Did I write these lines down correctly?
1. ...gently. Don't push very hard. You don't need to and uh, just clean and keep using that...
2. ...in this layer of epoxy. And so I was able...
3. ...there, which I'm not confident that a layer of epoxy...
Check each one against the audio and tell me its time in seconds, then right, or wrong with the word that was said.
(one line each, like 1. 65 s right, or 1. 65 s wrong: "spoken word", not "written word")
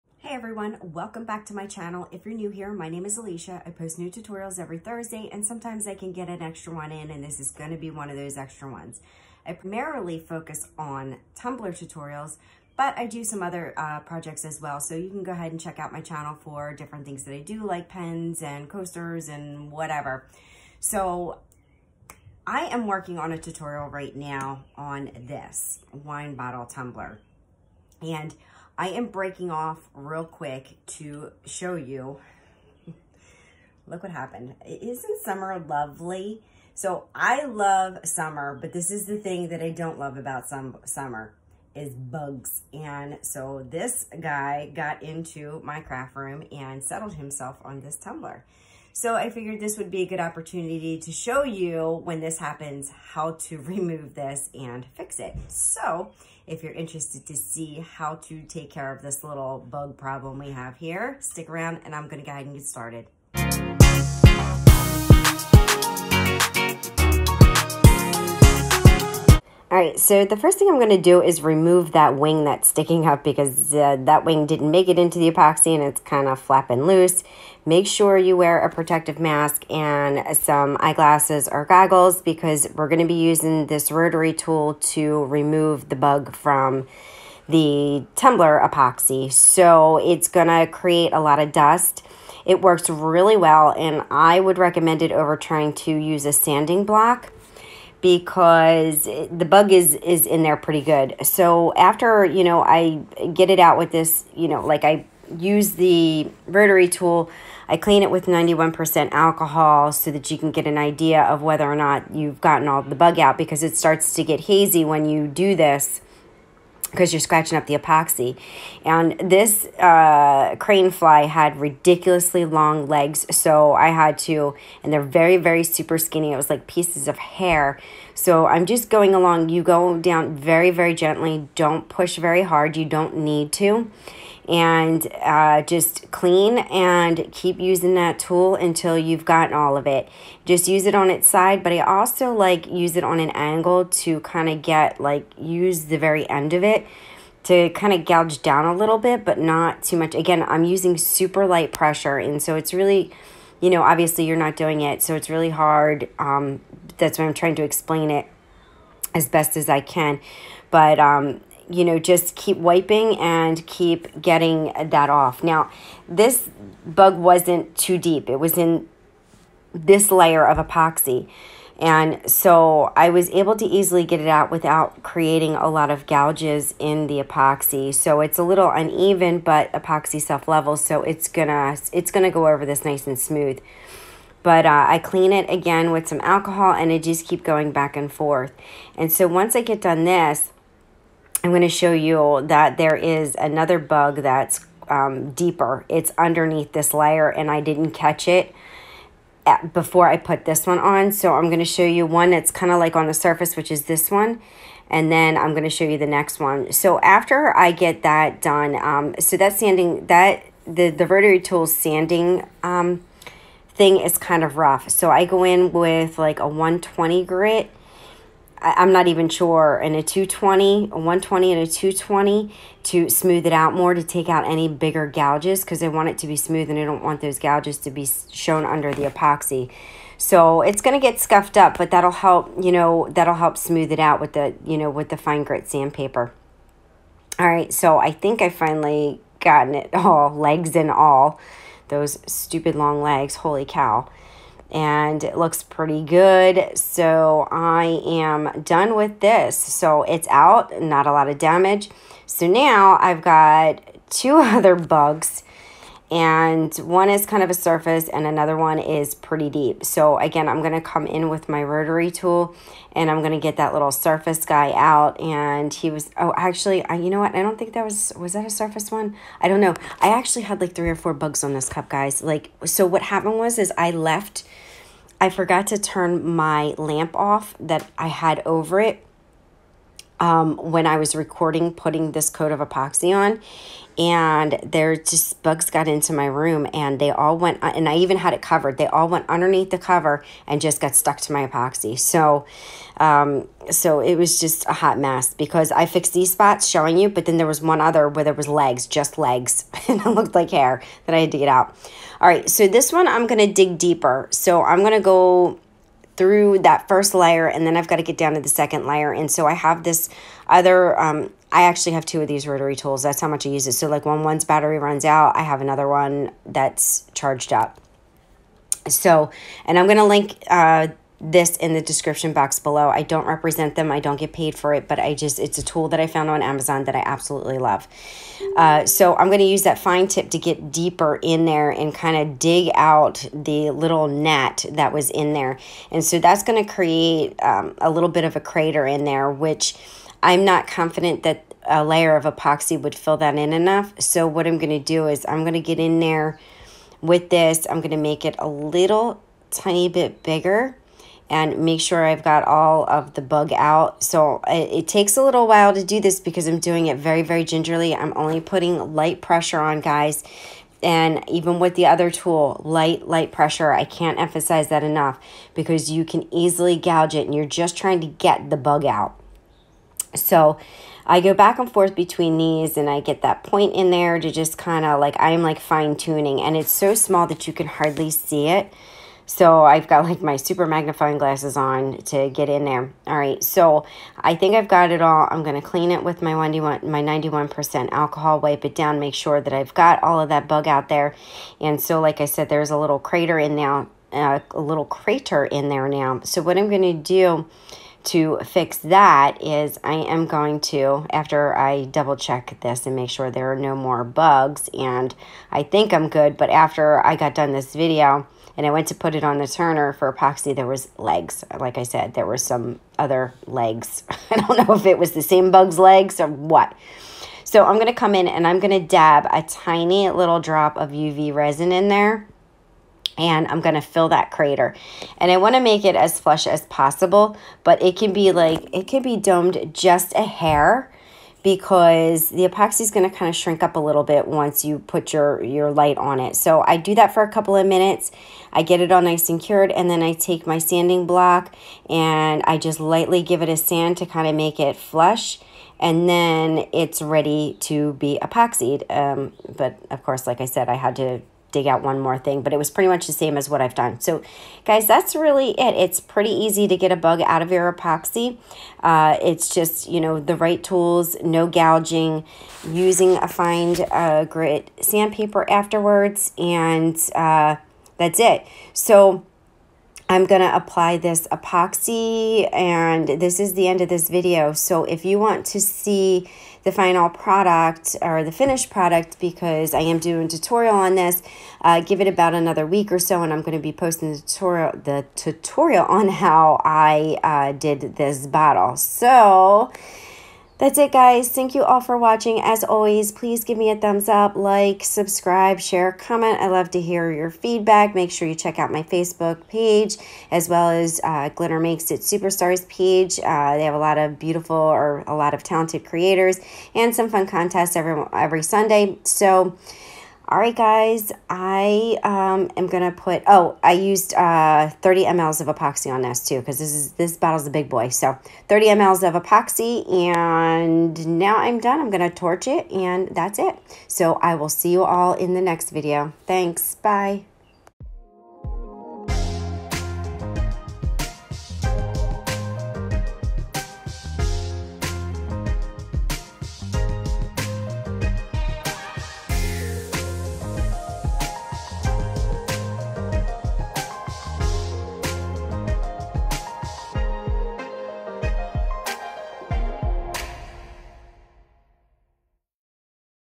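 1. 130 s right
2. 168 s right
3. 339 s right.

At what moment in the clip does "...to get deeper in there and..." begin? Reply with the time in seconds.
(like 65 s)
330 s.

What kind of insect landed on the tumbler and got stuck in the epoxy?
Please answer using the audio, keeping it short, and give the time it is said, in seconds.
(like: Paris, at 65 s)
Crane fly, at 120 s.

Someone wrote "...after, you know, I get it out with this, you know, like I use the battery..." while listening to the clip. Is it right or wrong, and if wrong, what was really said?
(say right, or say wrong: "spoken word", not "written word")
wrong: "rotary", not "battery".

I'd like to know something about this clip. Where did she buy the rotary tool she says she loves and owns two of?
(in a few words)
Amazon.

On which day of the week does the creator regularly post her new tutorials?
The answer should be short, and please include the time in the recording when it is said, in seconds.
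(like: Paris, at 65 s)
Thursday, at 4 s.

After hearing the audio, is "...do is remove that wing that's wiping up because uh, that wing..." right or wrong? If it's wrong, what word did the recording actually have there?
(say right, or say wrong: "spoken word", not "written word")
wrong: "sticking", not "wiping".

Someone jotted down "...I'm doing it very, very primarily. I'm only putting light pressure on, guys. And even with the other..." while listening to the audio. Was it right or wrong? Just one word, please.
wrong.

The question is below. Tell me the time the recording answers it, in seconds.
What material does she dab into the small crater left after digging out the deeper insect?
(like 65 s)
420 s.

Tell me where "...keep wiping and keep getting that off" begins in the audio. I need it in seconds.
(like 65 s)
162 s.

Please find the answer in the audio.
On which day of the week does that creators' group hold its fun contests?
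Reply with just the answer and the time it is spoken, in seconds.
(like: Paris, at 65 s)
Sunday, at 508 s.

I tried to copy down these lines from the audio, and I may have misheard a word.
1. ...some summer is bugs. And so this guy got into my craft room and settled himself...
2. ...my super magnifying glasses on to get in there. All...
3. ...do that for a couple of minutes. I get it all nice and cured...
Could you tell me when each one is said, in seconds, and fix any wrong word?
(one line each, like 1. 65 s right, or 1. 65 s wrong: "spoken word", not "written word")
1. 40 s right
2. 380 s right
3. 436 s right.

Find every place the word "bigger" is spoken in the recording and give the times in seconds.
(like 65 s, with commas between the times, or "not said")
224 s, 350 s.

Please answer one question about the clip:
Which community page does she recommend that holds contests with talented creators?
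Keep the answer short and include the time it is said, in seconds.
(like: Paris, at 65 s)
Glitter Makes It Superstars, at 501 s.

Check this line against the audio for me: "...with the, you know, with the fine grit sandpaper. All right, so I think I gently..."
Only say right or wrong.
wrong.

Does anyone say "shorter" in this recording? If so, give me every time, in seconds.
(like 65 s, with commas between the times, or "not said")
not said.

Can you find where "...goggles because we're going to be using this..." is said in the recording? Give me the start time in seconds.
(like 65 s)
81 s.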